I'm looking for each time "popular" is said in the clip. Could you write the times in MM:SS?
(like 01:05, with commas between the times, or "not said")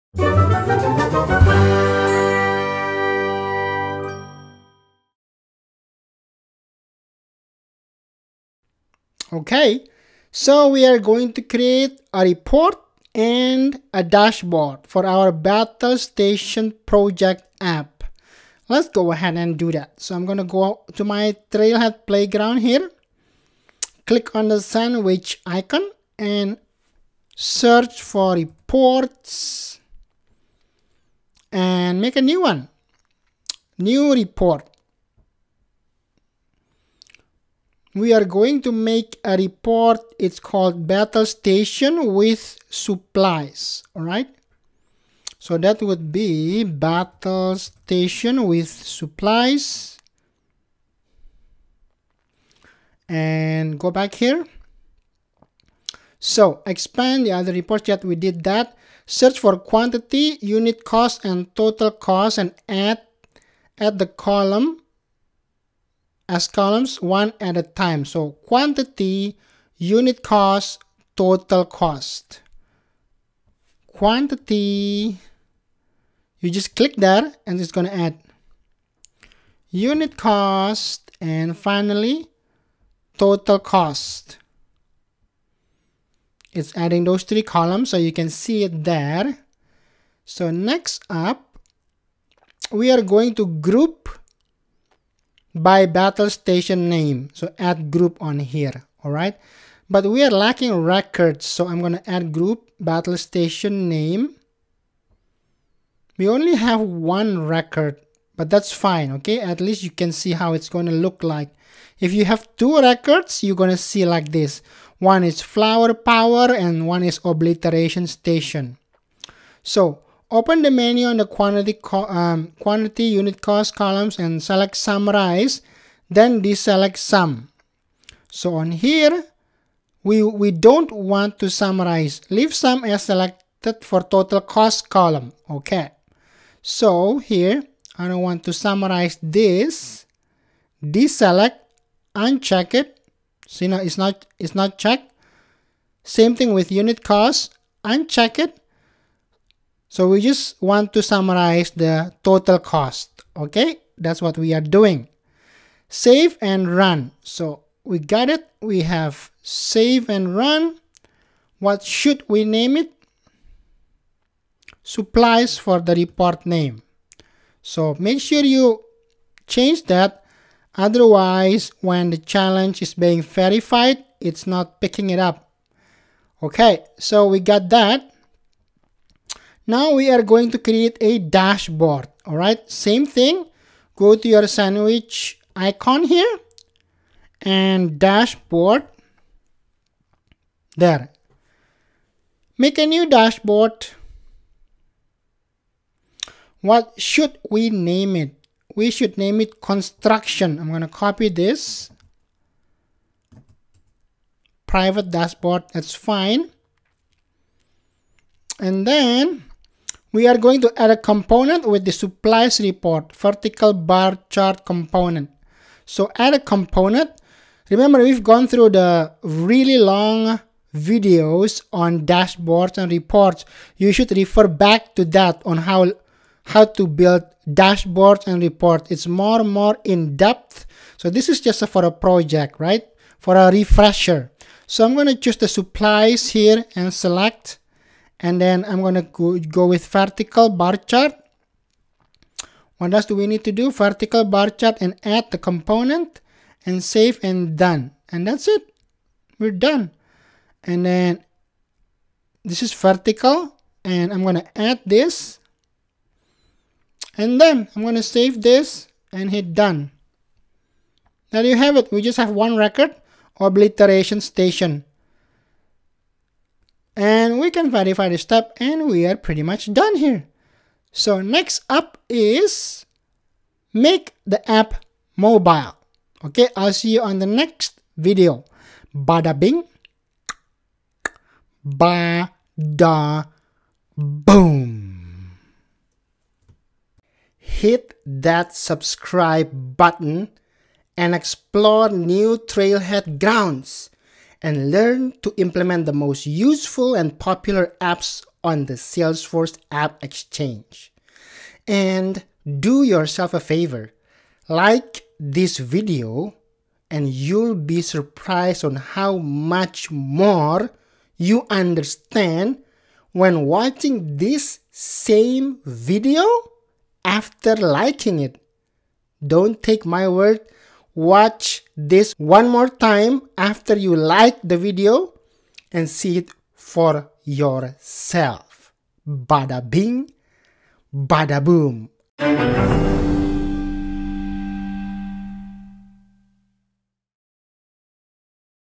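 04:57.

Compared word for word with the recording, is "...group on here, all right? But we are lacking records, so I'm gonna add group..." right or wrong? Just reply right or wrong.
right.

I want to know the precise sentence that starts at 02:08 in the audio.
So on here, we, we don't want to summarize.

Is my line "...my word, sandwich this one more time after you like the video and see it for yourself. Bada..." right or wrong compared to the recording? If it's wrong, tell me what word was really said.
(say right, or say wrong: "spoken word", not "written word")
wrong: "watch", not "sandwich".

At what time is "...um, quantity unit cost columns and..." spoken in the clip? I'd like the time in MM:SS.
02:01.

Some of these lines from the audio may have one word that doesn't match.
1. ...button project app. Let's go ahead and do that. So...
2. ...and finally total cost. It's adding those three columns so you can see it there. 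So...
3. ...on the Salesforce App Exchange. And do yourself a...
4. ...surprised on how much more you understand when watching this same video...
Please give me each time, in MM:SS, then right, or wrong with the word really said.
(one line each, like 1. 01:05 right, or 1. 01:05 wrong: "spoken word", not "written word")
1. 00:15 wrong: "station", not "button"
2. 01:21 right
3. 04:58 right
4. 05:07 right.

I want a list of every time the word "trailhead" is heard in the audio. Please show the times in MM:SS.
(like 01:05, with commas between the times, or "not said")
00:21, 04:52.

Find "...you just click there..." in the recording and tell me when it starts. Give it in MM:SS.
01:16.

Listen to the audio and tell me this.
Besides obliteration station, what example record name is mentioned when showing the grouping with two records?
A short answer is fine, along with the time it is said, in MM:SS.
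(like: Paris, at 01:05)
Flower power, at 01:55.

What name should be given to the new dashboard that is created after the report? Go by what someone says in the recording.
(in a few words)
Construction.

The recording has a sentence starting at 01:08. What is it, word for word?
So quantity, unit cost, total cost.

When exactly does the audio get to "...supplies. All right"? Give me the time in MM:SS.
00:42.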